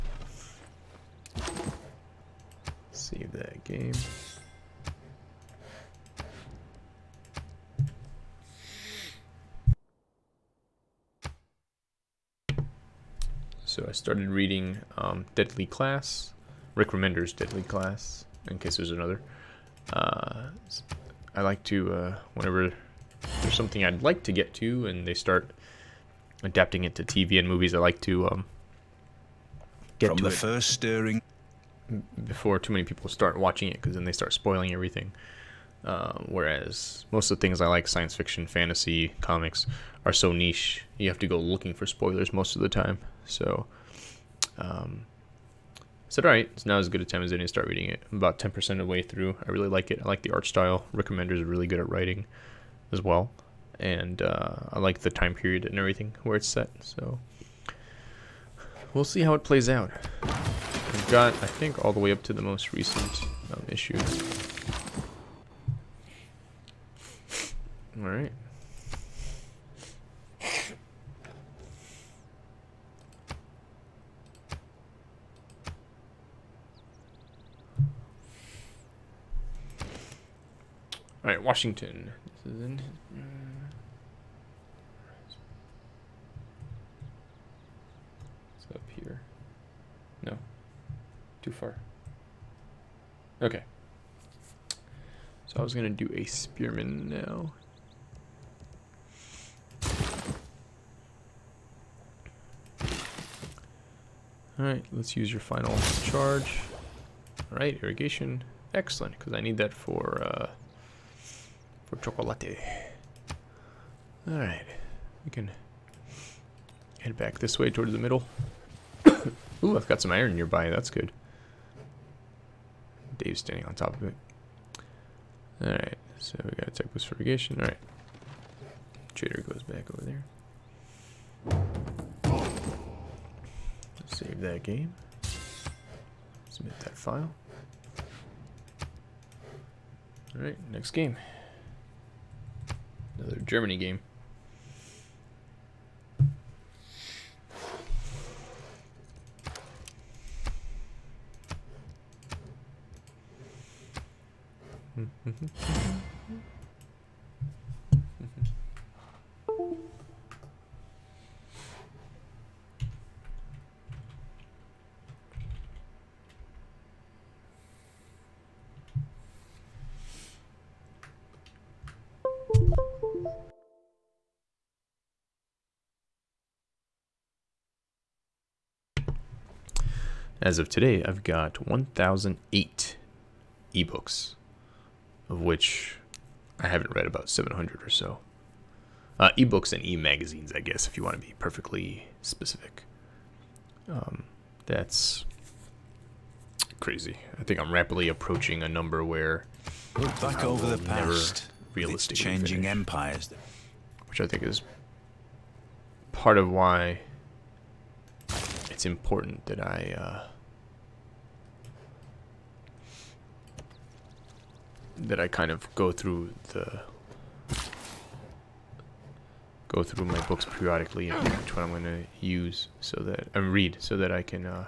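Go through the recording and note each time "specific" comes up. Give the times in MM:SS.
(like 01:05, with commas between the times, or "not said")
03:12.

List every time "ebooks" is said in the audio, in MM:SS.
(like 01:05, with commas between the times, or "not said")
03:03, 03:09.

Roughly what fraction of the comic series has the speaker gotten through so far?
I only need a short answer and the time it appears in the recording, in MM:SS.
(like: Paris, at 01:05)
10%, at 00:48.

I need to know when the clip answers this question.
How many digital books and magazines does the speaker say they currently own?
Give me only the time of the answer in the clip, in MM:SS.
03:01.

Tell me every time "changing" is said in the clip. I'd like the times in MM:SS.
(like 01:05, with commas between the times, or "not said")
03:22.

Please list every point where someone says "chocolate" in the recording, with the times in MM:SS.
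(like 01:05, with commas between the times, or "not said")
01:51.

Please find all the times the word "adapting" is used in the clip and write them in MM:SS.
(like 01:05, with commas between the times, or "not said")
00:26.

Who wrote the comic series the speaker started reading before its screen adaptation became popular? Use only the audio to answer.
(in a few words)
Rick Remender.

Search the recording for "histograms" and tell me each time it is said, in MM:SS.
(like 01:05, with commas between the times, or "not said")
not said.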